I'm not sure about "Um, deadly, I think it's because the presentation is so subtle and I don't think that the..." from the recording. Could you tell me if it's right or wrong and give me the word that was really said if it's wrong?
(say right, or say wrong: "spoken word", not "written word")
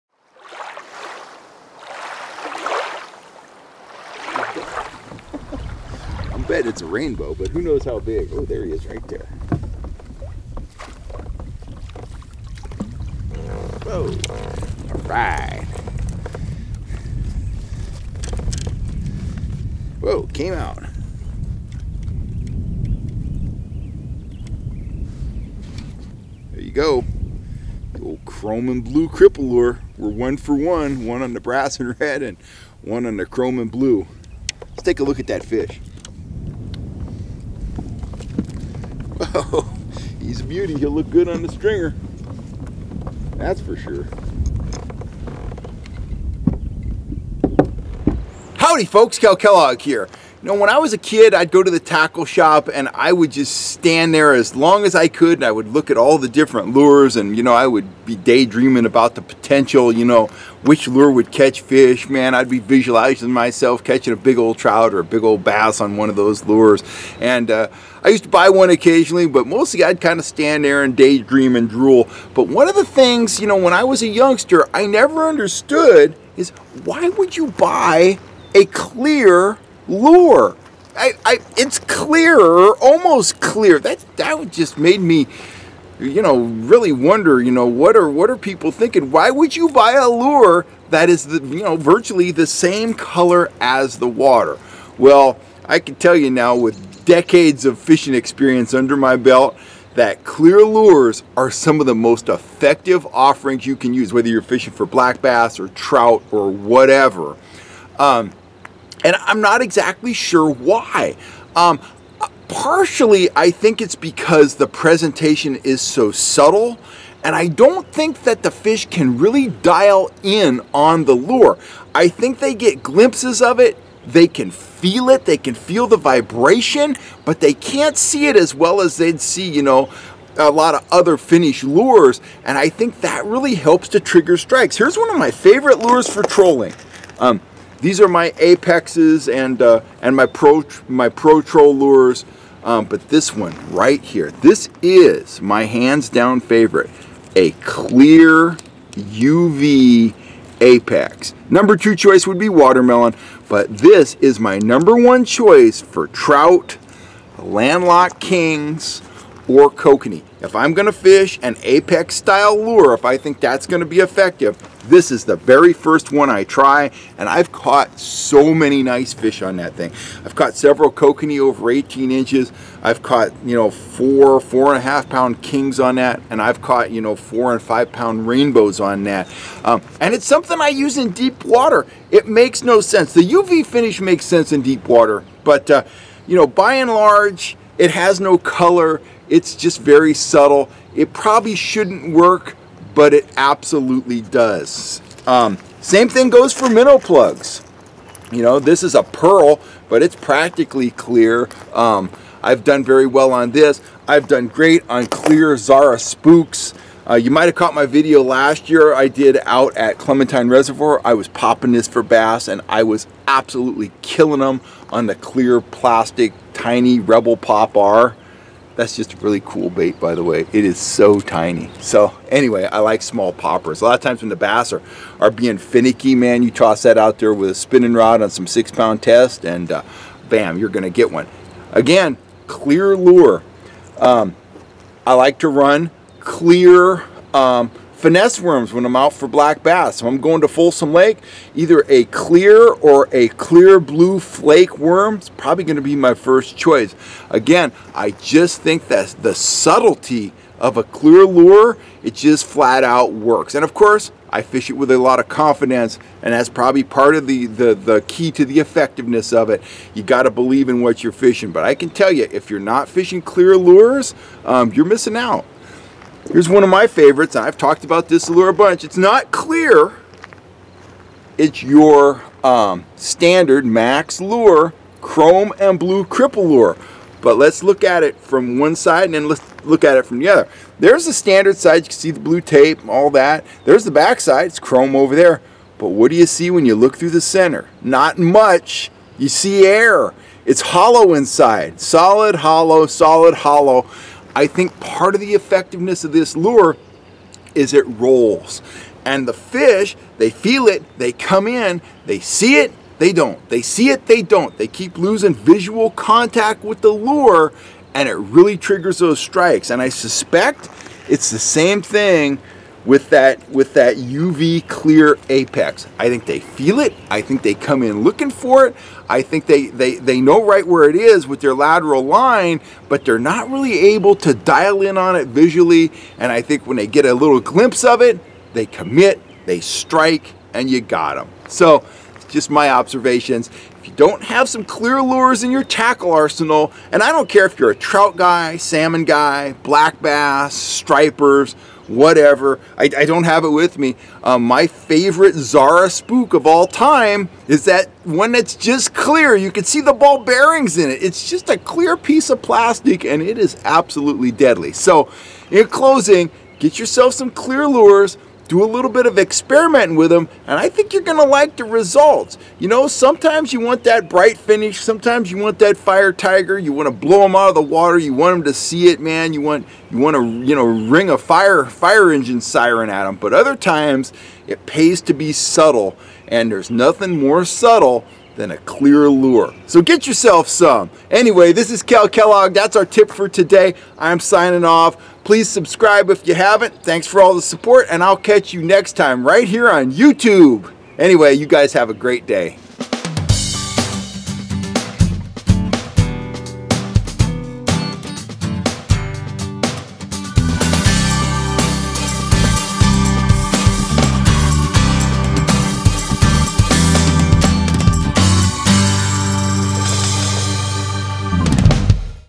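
wrong: "partially", not "deadly".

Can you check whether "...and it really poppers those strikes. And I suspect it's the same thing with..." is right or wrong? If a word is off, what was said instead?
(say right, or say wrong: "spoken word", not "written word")
wrong: "triggers", not "poppers".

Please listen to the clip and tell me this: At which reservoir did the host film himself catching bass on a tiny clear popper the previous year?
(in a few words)
Clementine Reservoir.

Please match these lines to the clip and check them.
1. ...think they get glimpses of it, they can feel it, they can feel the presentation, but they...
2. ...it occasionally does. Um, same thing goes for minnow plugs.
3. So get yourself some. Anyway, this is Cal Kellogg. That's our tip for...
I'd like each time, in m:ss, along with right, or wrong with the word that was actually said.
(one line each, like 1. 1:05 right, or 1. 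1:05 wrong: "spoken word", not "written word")
1. 2:02 wrong: "vibration", not "presentation"
2. 3:13 wrong: "absolutely", not "occasionally"
3. 6:19 right.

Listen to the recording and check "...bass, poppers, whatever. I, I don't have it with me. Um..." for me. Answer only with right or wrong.
wrong.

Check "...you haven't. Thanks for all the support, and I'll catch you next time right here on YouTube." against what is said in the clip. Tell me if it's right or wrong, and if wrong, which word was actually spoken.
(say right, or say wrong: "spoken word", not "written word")
right.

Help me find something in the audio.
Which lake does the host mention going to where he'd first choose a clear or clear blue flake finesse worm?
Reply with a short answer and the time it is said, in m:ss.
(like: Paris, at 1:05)
Folsom Lake, at 4:00.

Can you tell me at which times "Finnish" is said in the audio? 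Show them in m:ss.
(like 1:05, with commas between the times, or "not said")
2:11.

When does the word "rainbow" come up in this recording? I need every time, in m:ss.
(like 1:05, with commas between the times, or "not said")
0:06, 2:58.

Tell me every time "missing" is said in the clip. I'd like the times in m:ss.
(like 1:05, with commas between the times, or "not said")
4:24.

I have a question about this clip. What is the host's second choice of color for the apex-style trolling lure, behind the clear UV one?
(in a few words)
watermelon.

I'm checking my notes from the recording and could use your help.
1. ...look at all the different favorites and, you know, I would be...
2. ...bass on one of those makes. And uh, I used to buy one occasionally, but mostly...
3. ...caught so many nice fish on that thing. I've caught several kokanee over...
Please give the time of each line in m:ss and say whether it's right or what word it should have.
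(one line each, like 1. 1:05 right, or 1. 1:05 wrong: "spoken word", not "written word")
1. 0:55 wrong: "lures", not "favorites"
2. 1:05 wrong: "lures", not "makes"
3. 2:47 right.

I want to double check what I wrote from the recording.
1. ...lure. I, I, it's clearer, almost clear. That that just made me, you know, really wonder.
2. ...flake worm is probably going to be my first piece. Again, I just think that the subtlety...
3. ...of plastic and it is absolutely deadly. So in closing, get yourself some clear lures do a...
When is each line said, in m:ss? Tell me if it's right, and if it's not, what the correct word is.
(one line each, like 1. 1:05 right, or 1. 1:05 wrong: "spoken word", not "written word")
1. 1:19 right
2. 4:04 wrong: "choice", not "piece"
3. 5:52 right.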